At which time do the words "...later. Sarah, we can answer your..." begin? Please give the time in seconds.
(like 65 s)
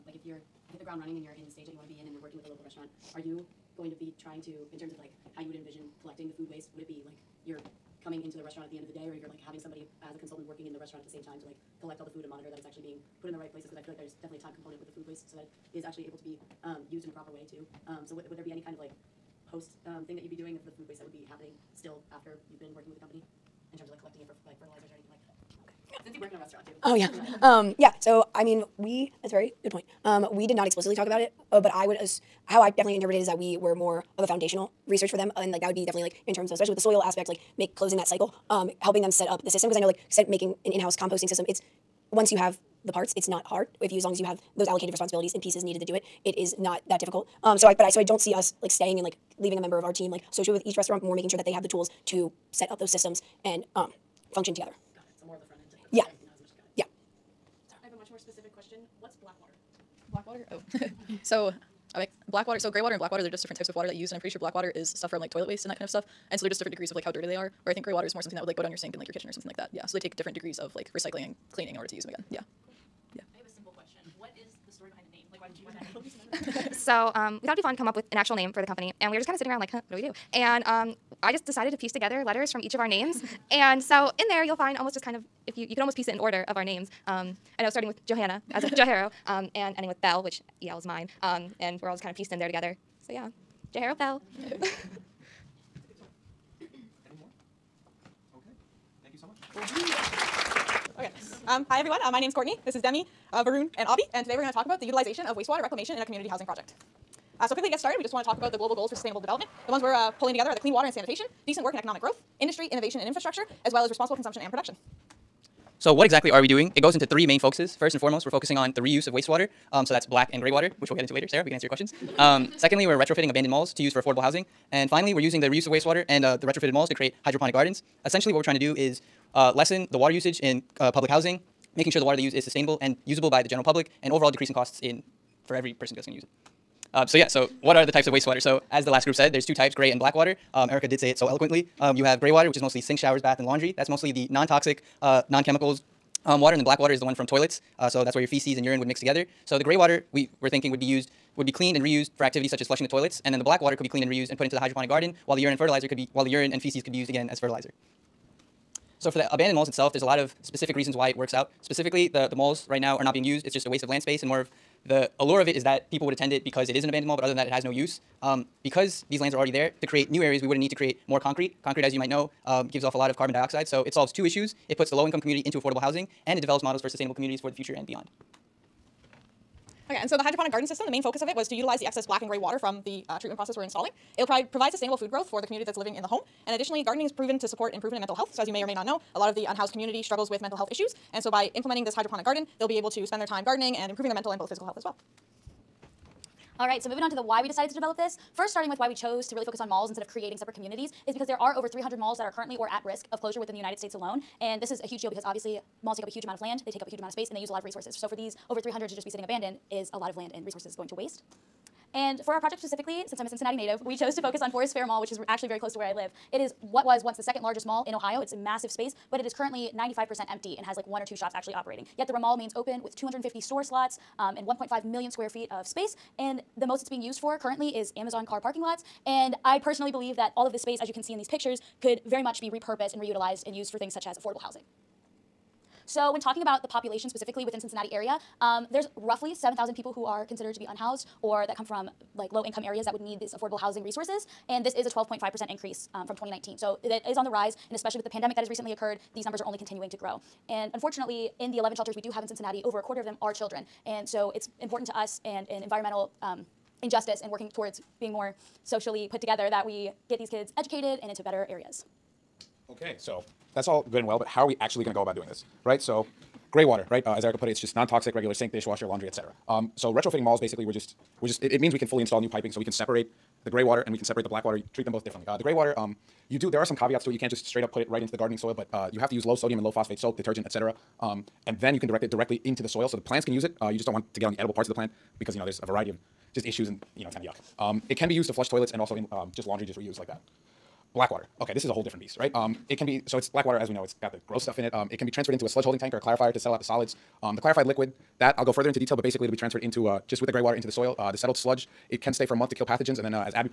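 121 s.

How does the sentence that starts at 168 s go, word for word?
Um, because these lands are already there, to create new areas, we wouldn't need to create more concrete.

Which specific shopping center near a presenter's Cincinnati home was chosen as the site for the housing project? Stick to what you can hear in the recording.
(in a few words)
Forest Fair Mall.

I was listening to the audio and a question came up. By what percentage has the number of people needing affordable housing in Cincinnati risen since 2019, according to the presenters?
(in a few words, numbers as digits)
12.5%.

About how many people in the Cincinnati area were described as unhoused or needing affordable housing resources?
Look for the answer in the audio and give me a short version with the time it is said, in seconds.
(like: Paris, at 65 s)
7,000, at 239 s.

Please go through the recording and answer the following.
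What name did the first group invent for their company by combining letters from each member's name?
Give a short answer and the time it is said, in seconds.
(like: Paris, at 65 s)
Jahero Bell, at 93 s.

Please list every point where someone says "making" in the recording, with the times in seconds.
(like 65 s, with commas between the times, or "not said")
40 s, 51 s, 131 s.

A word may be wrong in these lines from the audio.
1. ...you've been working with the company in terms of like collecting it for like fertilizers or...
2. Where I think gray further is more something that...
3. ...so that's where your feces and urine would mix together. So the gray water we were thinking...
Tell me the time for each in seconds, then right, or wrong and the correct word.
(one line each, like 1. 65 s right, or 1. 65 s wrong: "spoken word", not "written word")
1. 22 s right
2. 67 s wrong: "water", not "further"
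3. 147 s right.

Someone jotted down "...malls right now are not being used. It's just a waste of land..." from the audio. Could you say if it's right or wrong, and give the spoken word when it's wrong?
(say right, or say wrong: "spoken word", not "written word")
right.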